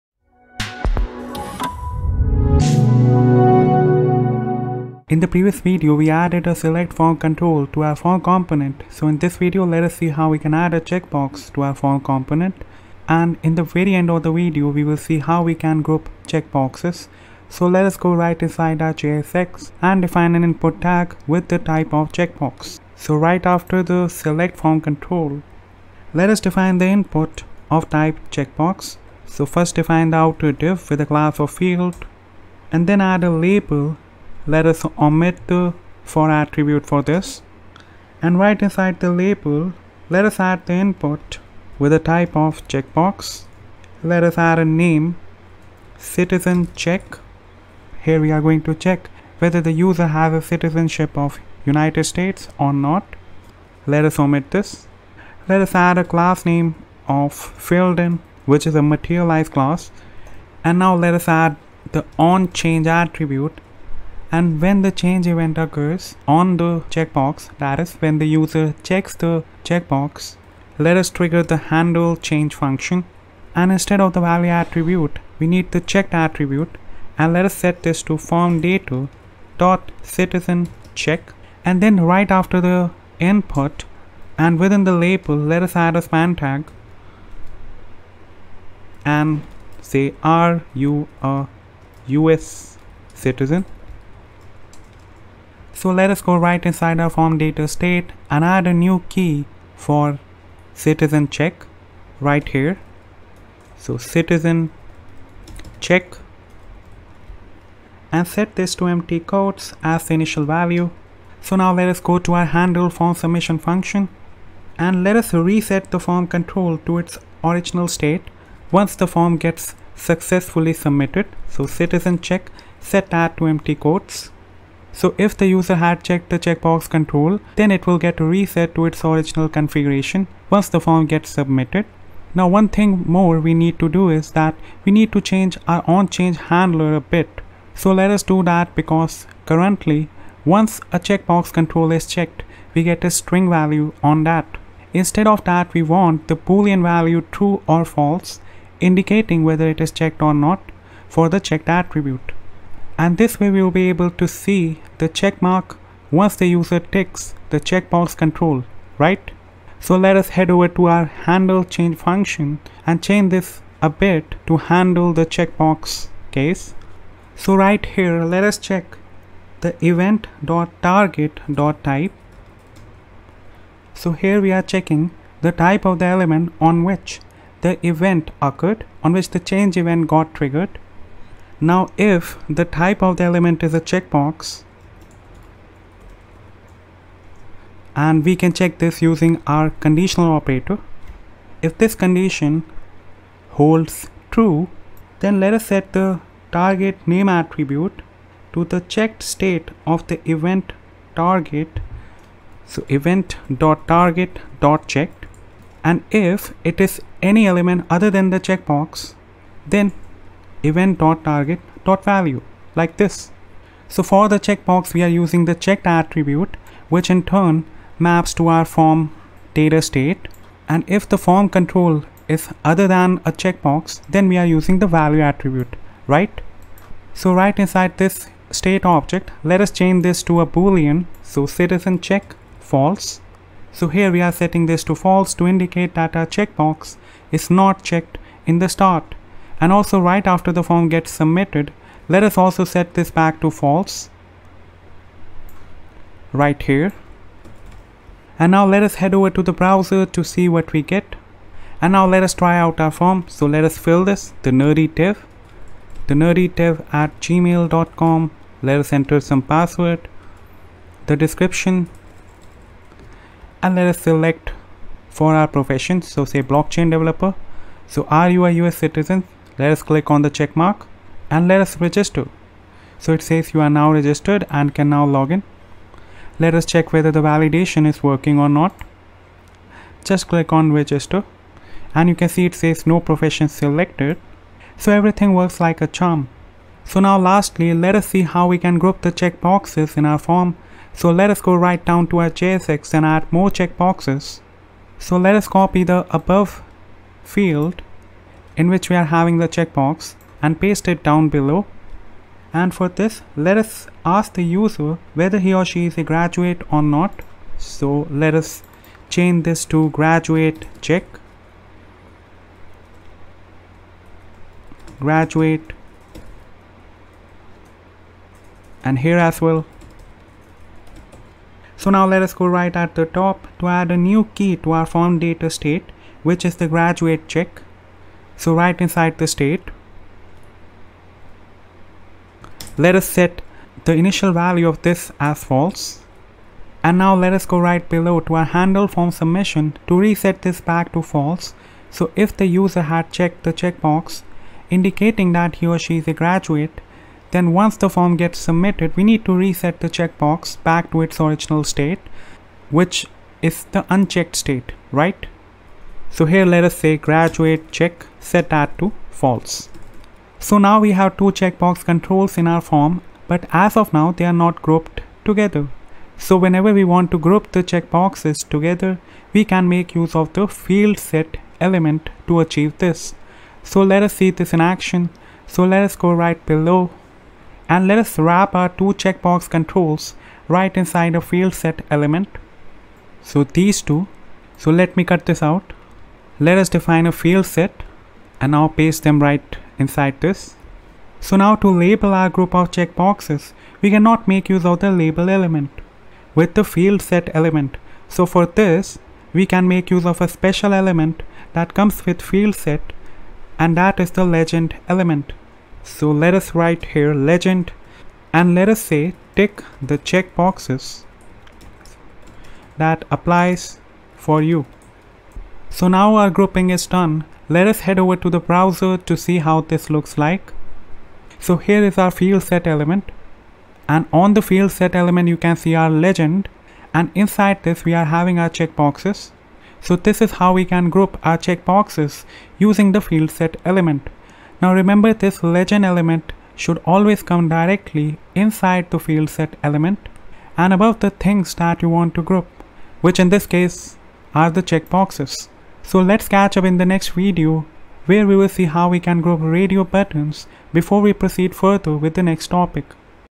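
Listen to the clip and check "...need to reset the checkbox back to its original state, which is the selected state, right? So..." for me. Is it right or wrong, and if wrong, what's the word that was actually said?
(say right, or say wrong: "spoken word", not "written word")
wrong: "unchecked", not "selected".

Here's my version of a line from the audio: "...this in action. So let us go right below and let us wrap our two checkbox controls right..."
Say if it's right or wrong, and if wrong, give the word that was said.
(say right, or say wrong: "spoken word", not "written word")
right.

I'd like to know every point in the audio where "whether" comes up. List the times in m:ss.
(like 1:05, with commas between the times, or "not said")
0:49, 2:29, 4:36, 5:05.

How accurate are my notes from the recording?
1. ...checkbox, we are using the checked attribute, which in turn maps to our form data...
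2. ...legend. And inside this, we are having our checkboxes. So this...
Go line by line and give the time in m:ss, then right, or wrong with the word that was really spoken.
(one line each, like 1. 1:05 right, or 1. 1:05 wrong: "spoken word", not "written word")
1. 3:34 right
2. 7:05 right.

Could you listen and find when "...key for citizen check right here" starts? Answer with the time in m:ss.
1:39.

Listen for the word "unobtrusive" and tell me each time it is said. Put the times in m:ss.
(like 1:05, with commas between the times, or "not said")
not said.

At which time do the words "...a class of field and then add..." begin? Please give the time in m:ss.
0:31.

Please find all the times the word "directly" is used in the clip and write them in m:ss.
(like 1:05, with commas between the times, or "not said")
7:17.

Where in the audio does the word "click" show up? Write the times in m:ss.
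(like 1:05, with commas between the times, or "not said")
4:29, 4:40.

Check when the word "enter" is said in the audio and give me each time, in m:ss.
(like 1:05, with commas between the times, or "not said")
4:18.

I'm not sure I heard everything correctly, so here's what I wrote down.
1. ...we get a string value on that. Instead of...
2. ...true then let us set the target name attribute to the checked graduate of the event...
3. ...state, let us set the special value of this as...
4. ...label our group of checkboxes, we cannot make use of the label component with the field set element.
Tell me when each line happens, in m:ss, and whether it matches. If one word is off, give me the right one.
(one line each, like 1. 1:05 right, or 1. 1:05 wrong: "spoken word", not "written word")
1. 2:22 right
2. 3:14 wrong: "state", not "graduate"
3. 5:29 wrong: "initial", not "special"
4. 6:31 wrong: "element", not "component".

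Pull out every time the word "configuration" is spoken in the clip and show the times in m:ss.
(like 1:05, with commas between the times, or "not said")
2:09.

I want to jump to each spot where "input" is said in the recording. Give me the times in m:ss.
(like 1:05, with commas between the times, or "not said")
0:20, 0:26, 0:40, 1:23.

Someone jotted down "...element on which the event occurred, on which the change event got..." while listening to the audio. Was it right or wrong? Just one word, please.
right.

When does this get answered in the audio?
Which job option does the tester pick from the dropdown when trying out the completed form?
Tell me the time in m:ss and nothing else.
4:26.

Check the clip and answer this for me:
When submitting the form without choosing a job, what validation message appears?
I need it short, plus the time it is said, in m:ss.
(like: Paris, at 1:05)
no profession selected, at 4:42.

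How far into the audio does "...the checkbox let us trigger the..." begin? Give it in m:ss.
1:09.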